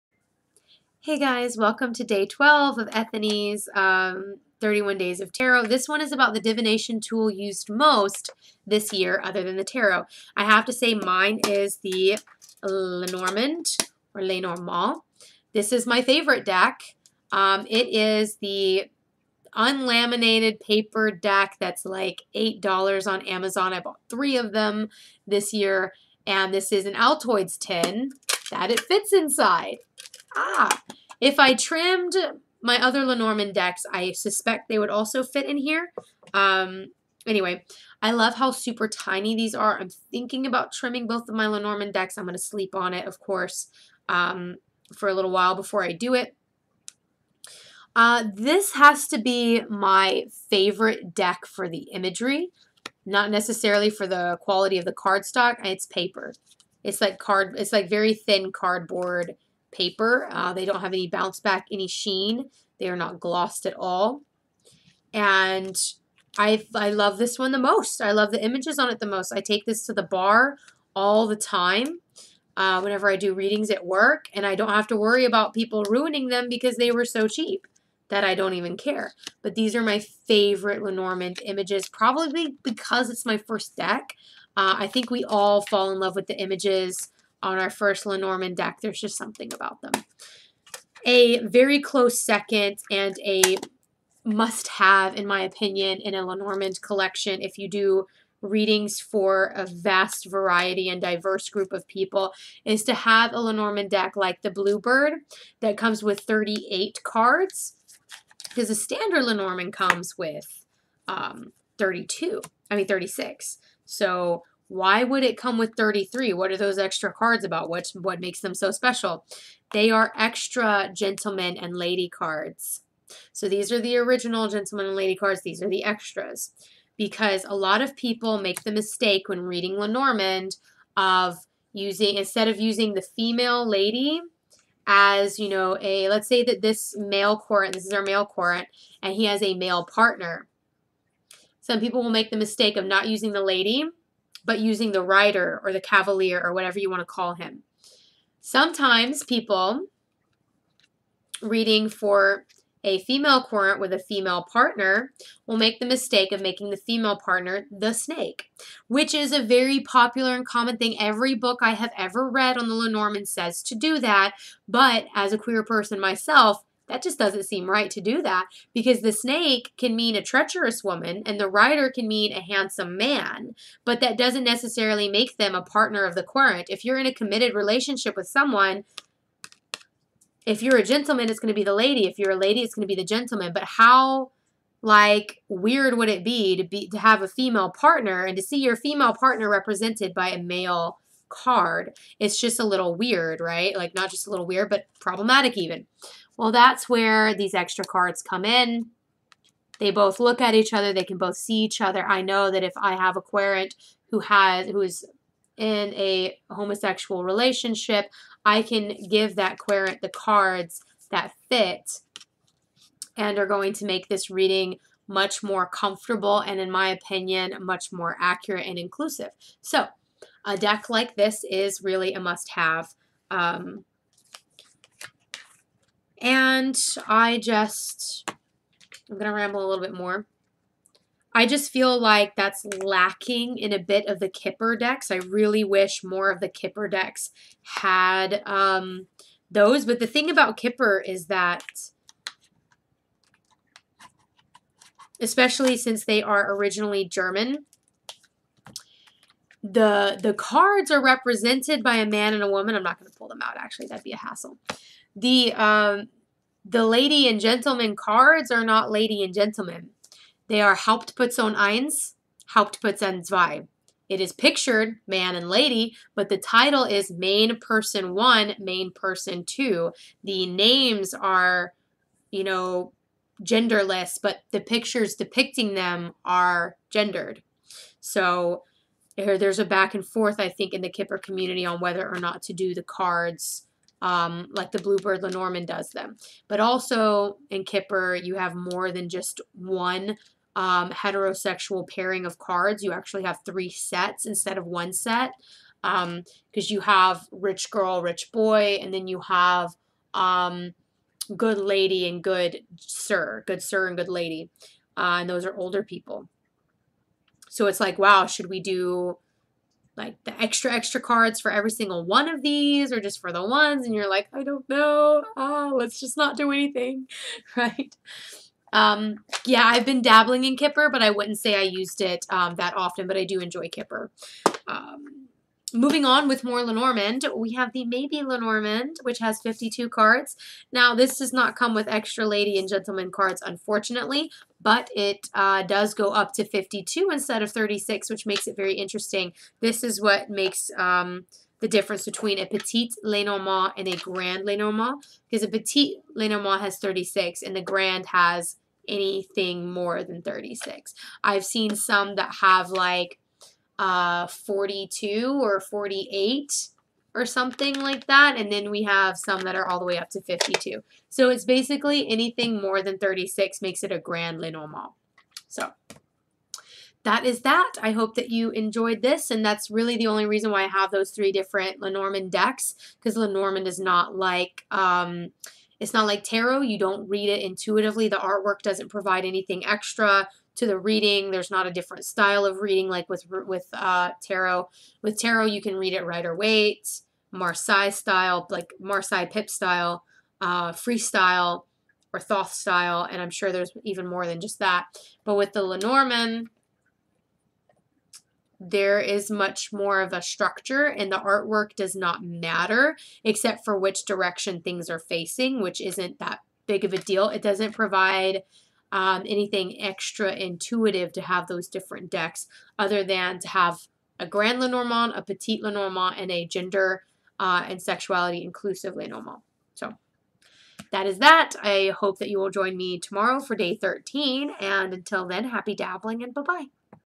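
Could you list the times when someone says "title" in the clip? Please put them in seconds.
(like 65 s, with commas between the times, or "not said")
266 s.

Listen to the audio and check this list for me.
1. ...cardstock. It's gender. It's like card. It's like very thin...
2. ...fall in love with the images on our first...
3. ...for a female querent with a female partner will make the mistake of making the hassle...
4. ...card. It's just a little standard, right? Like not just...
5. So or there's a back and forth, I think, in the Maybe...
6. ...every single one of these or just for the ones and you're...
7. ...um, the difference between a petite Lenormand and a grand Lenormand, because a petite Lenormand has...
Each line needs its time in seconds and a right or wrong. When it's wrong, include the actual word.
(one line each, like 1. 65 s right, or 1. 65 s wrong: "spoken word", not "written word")
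1. 54 s wrong: "paper", not "gender"
2. 85 s right
3. 151 s wrong: "female", not "hassle"
4. 191 s wrong: "weird", not "standard"
5. 278 s wrong: "Kipper", not "Maybe"
6. 311 s right
7. 340 s right.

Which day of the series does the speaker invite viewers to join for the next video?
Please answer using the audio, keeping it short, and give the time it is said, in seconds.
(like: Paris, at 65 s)
Day 13, at 423 s.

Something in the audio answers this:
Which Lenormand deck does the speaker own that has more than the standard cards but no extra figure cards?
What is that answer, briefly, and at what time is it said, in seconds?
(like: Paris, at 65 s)
Maybe Lenormand, at 327 s.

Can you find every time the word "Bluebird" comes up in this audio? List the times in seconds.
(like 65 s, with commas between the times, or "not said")
104 s, 284 s.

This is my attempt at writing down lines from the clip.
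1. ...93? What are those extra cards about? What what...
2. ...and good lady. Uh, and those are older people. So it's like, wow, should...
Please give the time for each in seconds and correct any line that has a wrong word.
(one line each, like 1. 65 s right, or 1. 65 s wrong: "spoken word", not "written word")
1. 115 s wrong: "33", not "93"
2. 303 s right.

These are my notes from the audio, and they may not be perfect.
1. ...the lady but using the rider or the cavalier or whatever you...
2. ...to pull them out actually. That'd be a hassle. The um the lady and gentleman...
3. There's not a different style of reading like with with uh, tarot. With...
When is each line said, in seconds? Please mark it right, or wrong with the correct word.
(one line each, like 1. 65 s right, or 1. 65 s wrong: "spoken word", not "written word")
1. 143 s right
2. 253 s right
3. 381 s right.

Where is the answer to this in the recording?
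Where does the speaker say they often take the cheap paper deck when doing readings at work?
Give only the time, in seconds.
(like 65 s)
69 s.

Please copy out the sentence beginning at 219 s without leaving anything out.
So, a deck like this is really a must have.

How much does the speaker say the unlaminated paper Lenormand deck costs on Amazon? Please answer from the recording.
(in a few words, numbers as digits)
$8.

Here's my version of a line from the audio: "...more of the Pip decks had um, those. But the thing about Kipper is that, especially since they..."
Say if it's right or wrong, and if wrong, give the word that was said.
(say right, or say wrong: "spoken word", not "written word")
wrong: "Kipper", not "Pip".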